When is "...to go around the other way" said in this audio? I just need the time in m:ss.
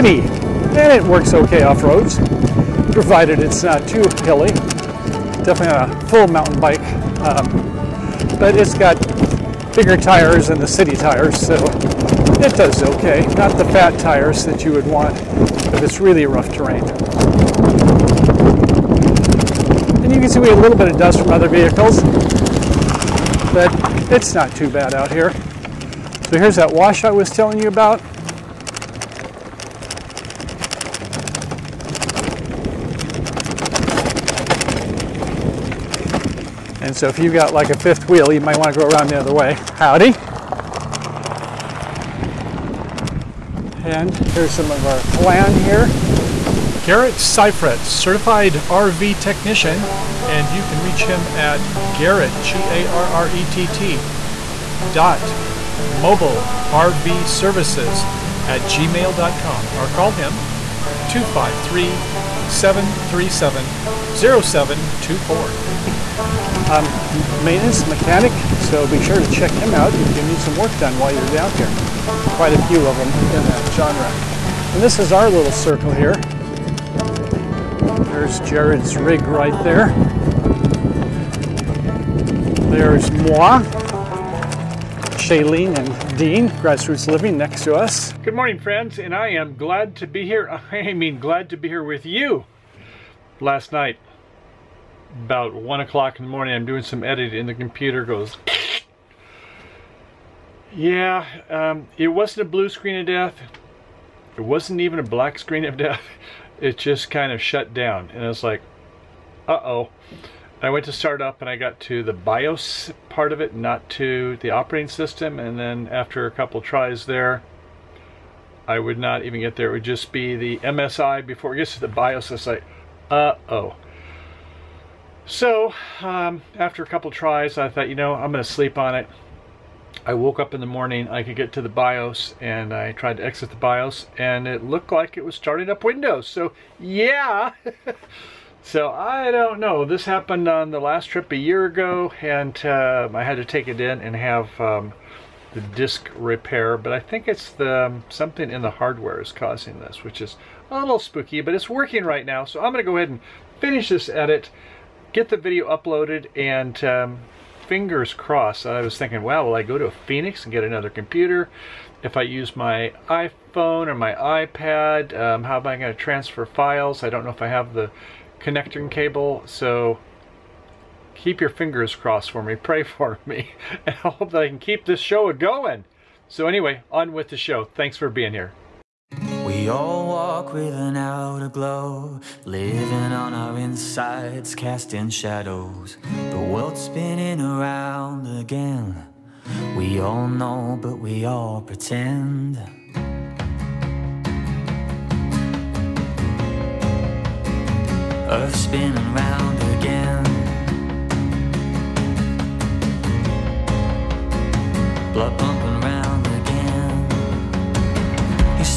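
0:38.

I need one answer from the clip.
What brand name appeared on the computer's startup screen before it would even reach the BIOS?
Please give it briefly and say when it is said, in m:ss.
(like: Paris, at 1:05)
MSI, at 2:00.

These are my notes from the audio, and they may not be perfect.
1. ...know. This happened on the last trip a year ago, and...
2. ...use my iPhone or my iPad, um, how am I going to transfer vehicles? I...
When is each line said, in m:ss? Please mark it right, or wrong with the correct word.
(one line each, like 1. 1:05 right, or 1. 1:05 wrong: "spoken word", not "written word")
1. 2:19 right
2. 2:42 wrong: "files", not "vehicles".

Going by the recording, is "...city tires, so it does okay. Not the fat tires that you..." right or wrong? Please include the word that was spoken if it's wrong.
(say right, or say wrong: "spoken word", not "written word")
right.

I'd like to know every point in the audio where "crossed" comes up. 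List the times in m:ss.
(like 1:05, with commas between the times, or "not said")
2:38, 2:51.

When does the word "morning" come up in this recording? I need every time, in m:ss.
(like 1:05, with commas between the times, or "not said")
1:28, 1:36, 2:10.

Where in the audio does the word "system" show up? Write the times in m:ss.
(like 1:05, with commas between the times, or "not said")
1:54.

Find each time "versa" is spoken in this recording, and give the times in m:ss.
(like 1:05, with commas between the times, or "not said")
not said.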